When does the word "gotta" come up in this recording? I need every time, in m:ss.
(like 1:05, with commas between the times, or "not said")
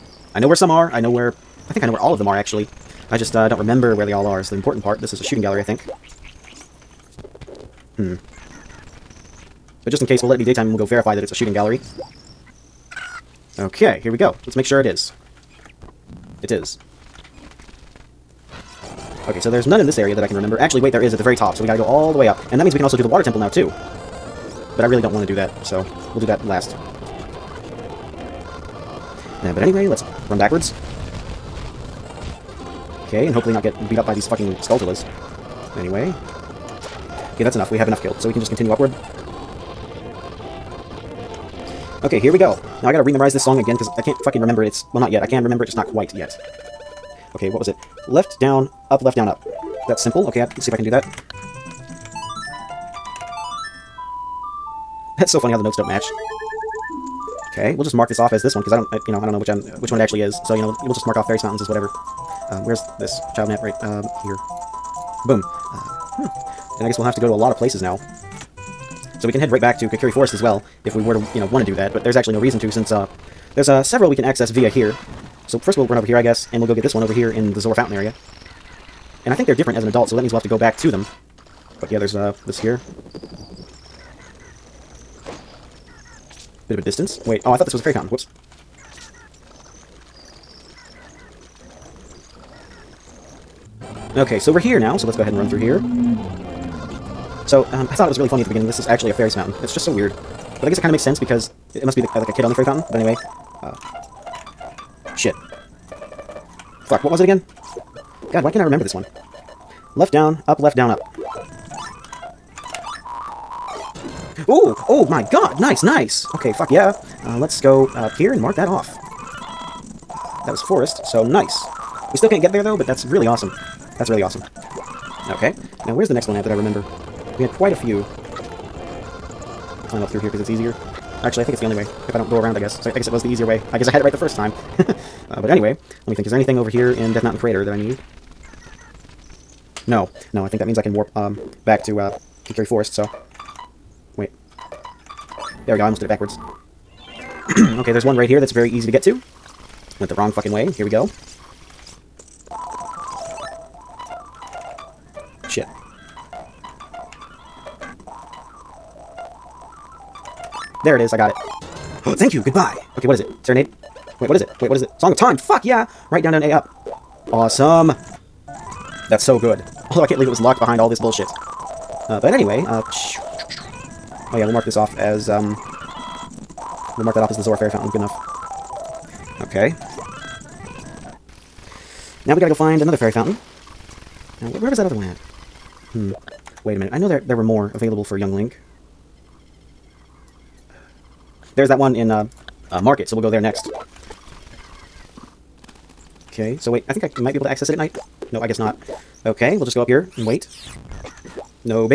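0:21, 0:42, 3:02.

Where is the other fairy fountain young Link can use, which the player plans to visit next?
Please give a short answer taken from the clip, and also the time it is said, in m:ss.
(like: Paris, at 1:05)
market, at 3:12.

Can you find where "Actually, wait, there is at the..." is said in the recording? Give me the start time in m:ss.
0:20.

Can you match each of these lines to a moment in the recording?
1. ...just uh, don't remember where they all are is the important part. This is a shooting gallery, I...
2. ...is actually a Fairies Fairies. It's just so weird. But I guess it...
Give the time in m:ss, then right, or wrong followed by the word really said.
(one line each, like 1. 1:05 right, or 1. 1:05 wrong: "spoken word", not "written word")
1. 0:03 right
2. 1:38 wrong: "Mountain", not "Fairies".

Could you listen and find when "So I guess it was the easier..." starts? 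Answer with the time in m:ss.
2:12.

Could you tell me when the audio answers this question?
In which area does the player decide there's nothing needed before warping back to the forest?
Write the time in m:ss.
2:17.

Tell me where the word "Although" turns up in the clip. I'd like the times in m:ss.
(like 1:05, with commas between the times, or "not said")
2:49.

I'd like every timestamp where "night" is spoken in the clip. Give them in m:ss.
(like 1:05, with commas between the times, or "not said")
3:17.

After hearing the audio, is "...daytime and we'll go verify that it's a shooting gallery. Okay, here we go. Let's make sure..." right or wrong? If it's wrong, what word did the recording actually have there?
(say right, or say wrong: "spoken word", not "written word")
right.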